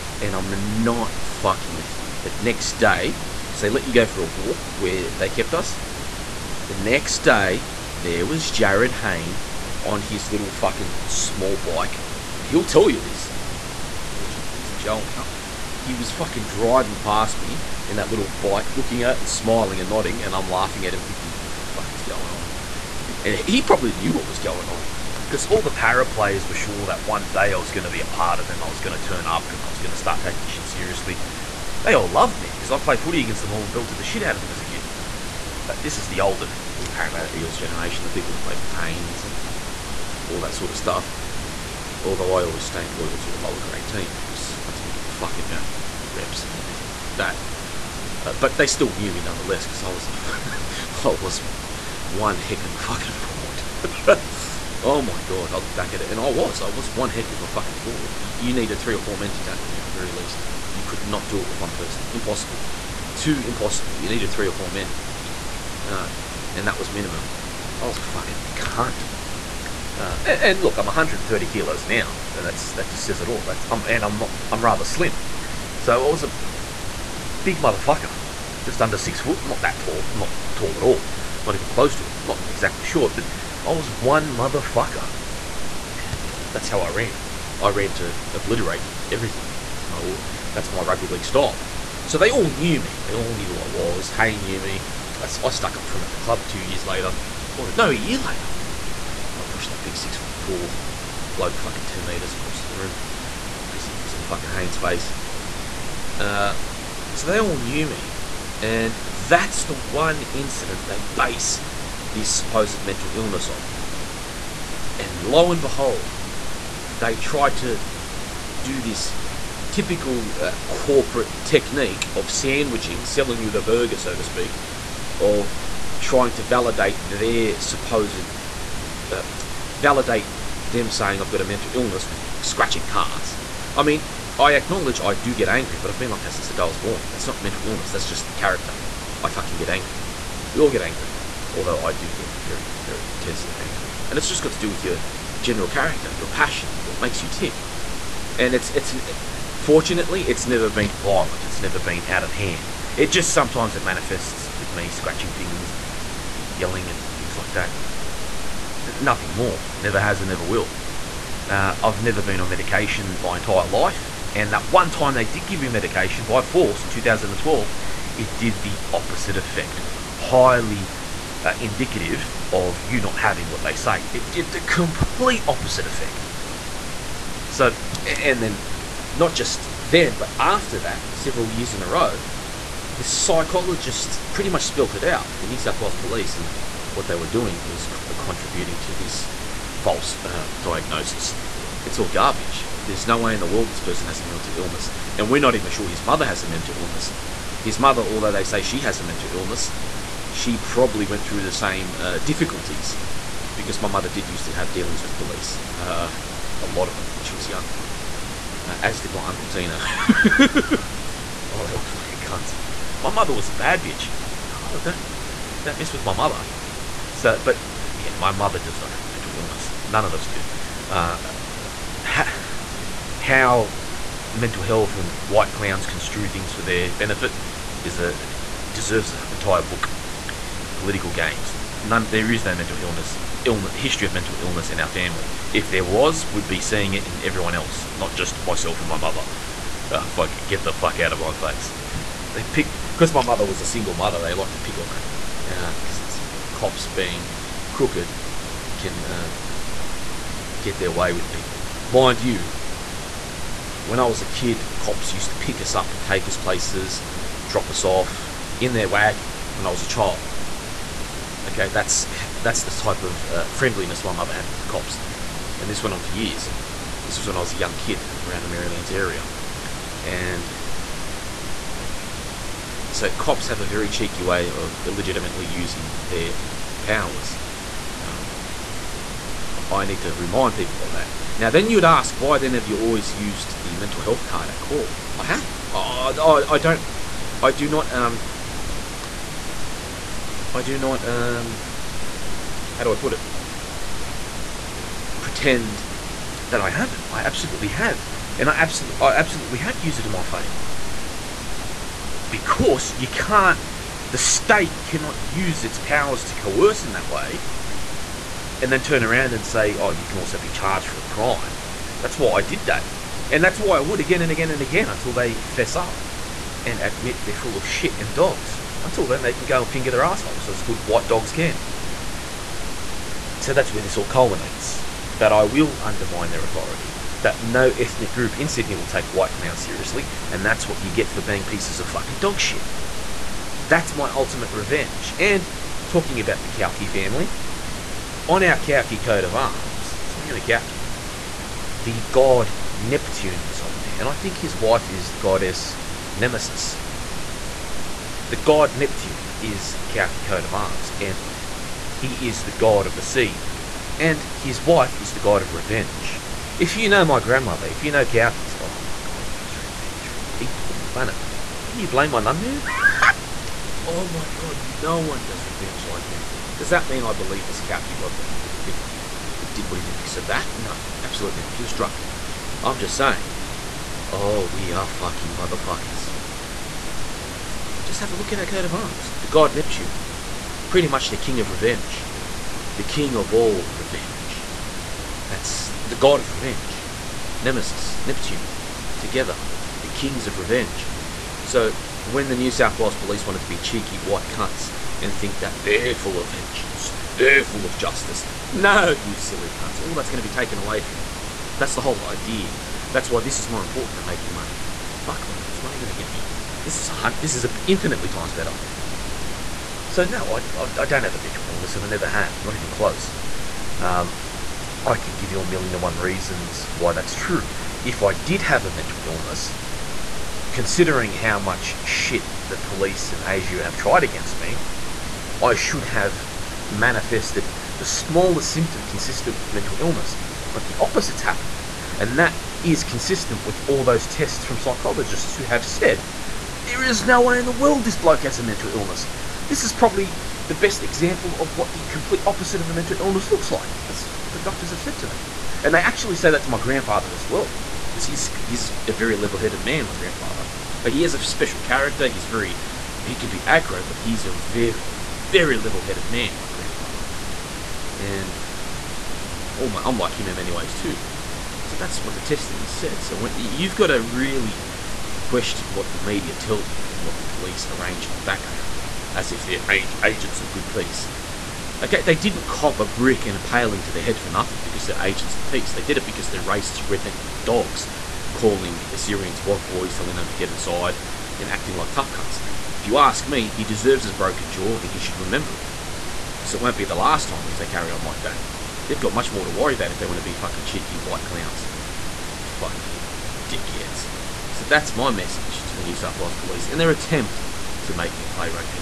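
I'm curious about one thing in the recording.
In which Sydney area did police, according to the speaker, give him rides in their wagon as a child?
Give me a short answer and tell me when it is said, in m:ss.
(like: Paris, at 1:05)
Merrylands, at 4:28.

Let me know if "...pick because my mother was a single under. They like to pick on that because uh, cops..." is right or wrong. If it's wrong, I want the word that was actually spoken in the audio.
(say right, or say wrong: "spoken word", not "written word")
wrong: "mother", not "under".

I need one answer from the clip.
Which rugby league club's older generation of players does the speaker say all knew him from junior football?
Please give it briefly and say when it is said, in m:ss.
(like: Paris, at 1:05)
Parramatta Eels, at 0:36.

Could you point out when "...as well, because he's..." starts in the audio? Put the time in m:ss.
7:27.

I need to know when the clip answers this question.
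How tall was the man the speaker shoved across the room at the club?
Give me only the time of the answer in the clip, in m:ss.
1:39.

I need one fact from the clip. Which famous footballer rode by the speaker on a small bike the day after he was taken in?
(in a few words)
Jarryd Hayne.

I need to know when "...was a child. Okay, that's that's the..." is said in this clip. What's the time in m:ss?
4:19.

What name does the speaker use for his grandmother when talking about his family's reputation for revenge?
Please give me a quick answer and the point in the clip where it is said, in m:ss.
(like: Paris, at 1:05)
Nunnu, at 6:02.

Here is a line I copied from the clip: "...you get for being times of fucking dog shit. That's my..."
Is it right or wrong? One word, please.
wrong.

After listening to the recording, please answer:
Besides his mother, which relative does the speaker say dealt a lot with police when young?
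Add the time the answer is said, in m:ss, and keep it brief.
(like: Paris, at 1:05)
Uncle Tina, at 3:29.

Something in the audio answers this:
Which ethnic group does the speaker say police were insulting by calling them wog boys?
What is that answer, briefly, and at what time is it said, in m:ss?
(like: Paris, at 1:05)
Assyrians, at 7:58.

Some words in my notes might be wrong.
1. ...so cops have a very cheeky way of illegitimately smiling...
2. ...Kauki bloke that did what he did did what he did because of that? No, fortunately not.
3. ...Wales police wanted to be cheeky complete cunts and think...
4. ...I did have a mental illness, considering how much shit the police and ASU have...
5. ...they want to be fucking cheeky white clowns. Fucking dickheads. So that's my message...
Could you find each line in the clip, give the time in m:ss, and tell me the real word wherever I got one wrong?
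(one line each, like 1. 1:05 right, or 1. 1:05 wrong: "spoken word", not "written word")
1. 4:32 wrong: "using", not "smiling"
2. 6:07 wrong: "absolutely", not "fortunately"
3. 6:32 wrong: "white", not "complete"
4. 6:58 right
5. 8:09 right.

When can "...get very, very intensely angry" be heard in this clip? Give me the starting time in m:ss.
2:22.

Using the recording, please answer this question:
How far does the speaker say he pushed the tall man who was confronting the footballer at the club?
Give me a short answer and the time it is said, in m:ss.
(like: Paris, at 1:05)
10 metres, at 1:41.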